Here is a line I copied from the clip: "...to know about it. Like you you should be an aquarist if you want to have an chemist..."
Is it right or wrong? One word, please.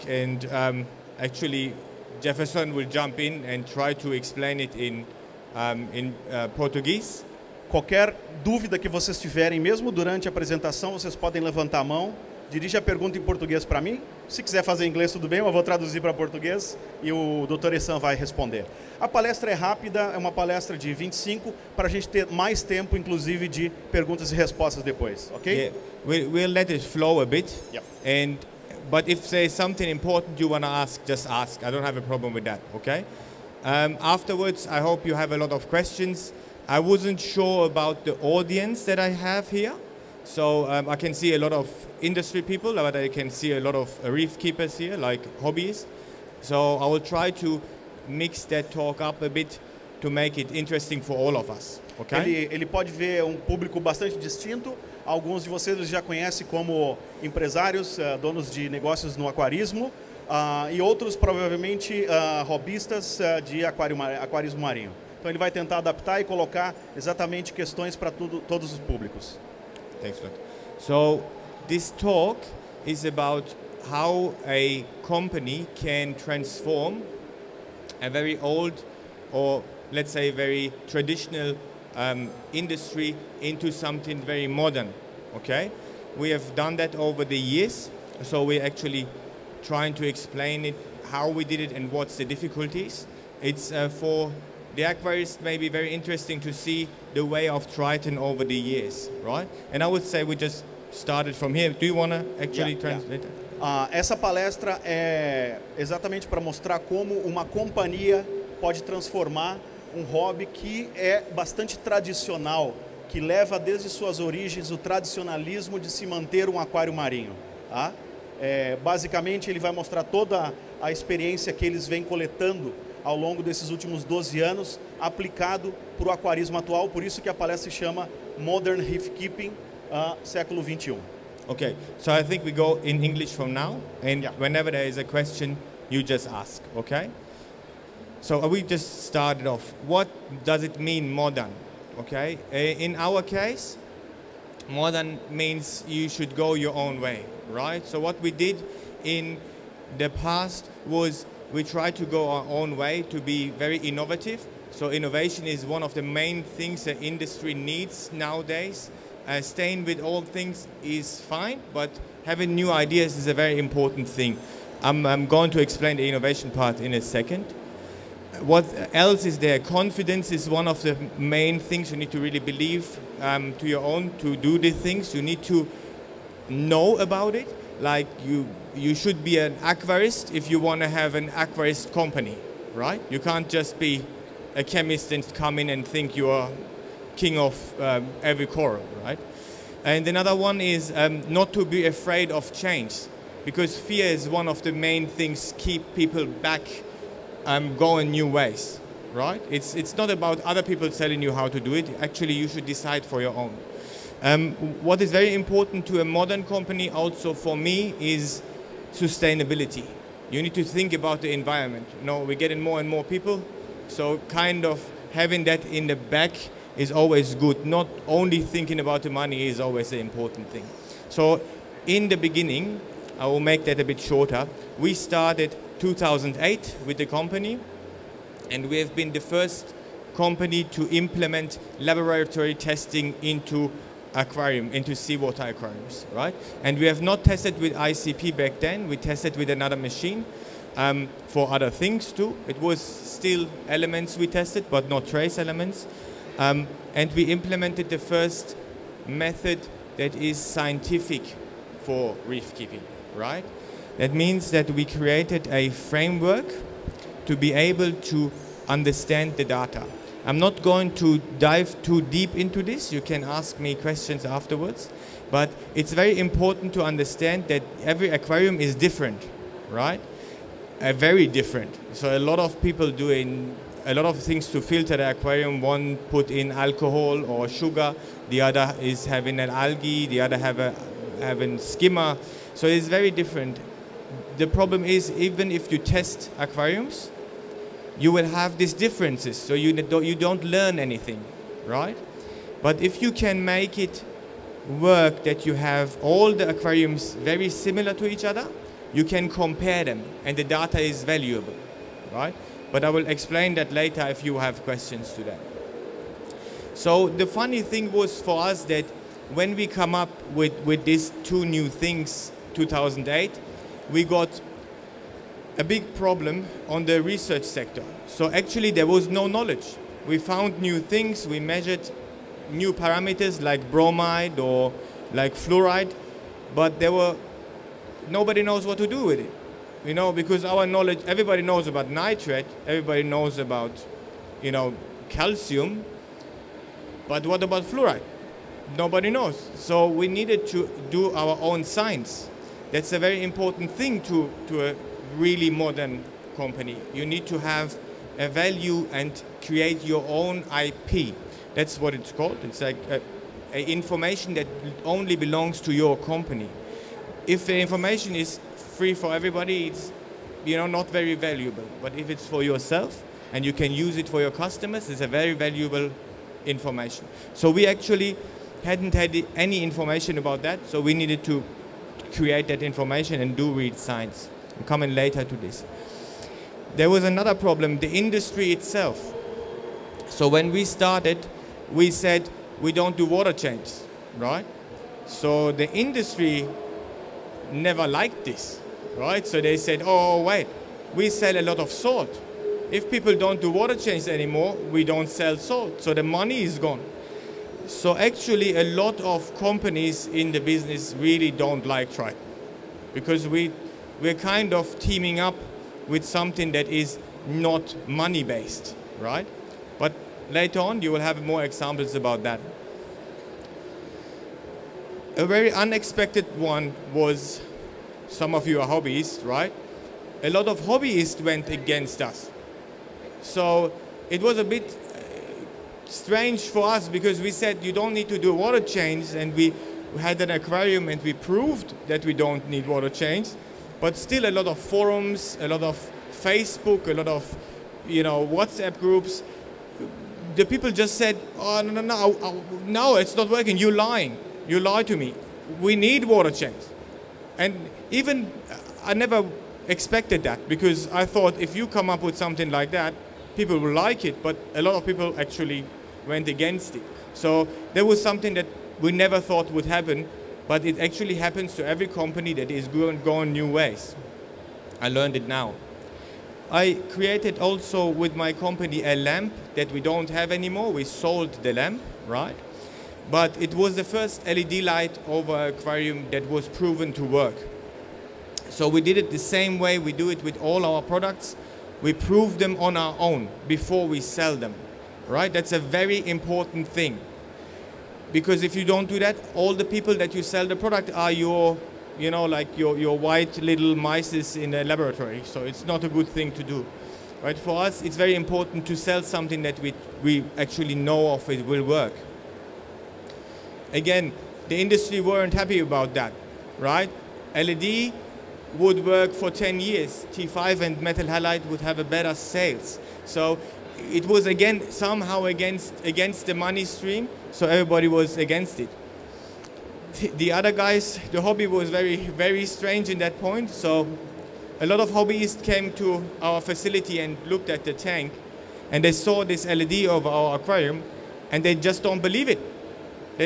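wrong.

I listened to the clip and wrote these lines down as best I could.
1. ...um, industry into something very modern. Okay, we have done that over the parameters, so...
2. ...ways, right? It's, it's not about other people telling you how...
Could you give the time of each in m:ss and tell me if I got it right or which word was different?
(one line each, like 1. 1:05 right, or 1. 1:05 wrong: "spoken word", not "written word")
1. 1:21 wrong: "years", not "parameters"
2. 3:18 right.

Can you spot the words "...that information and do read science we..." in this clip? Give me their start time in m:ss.
6:12.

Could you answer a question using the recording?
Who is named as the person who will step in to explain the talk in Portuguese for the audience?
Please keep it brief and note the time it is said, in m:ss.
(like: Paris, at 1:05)
Jefferson, at 0:02.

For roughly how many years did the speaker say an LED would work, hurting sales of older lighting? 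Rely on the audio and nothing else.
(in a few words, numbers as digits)
10.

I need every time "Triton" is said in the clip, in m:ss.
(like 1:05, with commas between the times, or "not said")
1:37, 6:41.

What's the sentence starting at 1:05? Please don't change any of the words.
Então ele vai tentar adaptar e colocar exatamente questões para todos os públicos.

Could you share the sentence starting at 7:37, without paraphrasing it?
So there was something that we never thought would happen but it actually happens to every company that is going new ways.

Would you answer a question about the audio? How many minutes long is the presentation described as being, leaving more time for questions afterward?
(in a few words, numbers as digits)
25.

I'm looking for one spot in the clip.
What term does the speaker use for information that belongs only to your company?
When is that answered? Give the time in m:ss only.
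5:50.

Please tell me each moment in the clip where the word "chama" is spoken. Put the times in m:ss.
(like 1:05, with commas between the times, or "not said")
2:07.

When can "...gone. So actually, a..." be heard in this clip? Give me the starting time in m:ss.
6:36.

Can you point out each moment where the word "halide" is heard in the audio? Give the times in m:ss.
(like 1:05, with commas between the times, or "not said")
8:31.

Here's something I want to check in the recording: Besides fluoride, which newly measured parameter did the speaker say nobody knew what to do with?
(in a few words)
bromide.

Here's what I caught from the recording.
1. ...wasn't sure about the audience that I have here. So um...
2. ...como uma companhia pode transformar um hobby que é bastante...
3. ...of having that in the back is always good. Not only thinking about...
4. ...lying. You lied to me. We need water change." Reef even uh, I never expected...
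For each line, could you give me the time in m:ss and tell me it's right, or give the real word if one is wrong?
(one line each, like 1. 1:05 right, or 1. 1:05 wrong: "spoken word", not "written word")
1. 0:36 right
2. 1:46 right
3. 3:34 right
4. 7:23 wrong: "And", not "Reef".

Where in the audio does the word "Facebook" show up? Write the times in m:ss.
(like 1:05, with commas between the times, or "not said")
7:16.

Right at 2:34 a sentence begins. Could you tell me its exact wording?
So innovation is one of the main things the industry needs nowadays.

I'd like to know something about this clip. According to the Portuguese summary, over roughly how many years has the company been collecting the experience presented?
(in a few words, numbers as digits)
12.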